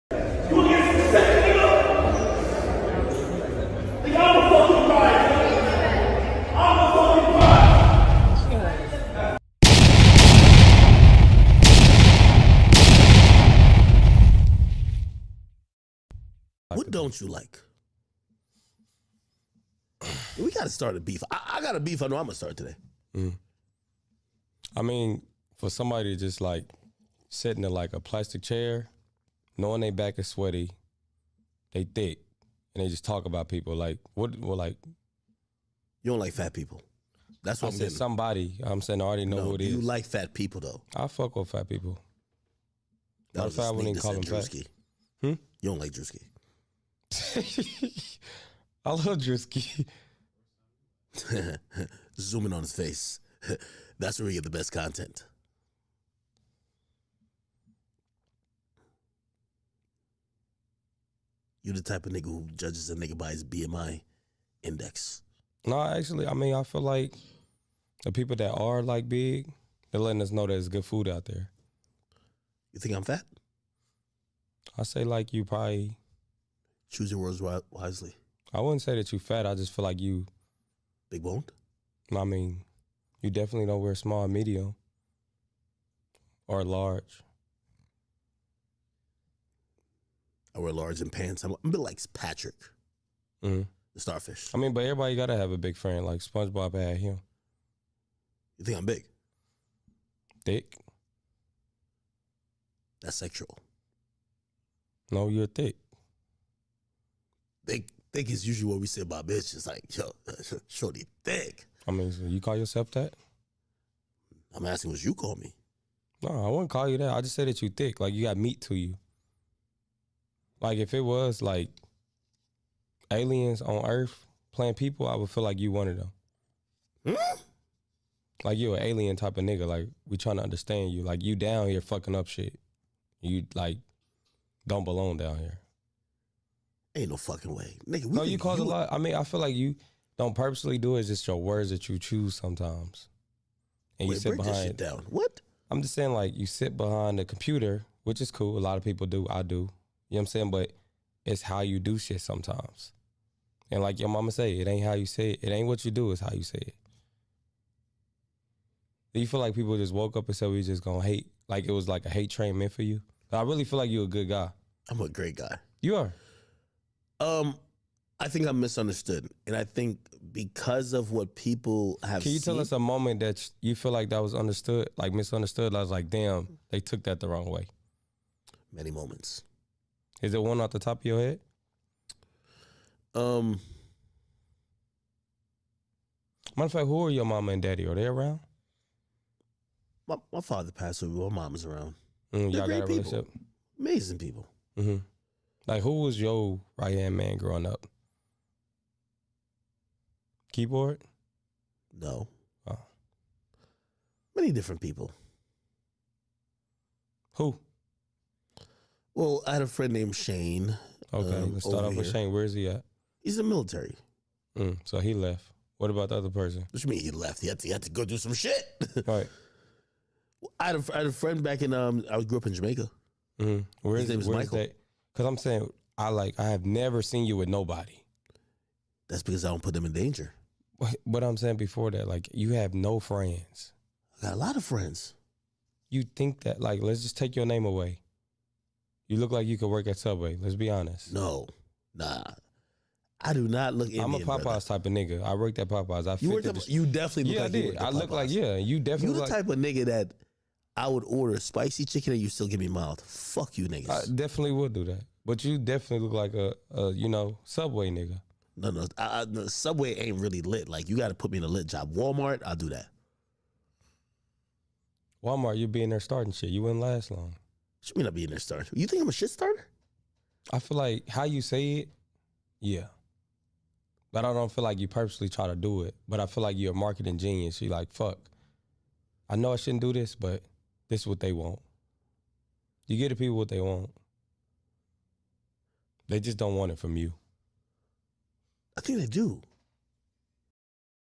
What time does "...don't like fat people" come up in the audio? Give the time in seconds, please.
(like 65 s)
36 s.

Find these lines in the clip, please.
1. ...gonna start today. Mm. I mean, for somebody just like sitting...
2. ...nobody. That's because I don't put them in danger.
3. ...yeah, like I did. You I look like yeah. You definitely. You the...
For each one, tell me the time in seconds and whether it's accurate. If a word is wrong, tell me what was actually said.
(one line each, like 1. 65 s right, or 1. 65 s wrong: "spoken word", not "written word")
1. 22 s right
2. 227 s right
3. 247 s right.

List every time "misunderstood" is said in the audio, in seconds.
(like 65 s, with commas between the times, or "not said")
168 s, 175 s.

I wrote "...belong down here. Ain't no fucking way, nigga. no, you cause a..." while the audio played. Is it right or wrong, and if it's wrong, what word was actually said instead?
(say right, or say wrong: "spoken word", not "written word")
right.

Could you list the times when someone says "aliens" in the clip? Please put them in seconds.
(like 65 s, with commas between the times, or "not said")
123 s, 128 s.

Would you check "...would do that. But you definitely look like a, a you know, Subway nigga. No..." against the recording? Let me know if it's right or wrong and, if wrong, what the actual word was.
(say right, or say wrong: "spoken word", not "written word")
right.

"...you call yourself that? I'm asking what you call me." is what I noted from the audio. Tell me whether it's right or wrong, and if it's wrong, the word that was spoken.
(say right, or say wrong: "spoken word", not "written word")
right.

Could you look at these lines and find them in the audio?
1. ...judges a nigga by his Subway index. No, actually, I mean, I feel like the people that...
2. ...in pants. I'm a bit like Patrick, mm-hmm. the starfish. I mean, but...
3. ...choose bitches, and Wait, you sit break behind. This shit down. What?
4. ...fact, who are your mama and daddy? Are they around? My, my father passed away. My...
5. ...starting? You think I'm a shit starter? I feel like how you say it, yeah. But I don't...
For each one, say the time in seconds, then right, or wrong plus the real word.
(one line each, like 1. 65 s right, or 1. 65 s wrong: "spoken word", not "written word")
1. 62 s wrong: "BMI", not "Subway"
2. 90 s right
3. 141 s wrong: "sometimes", not "bitches"
4. 186 s right
5. 268 s right.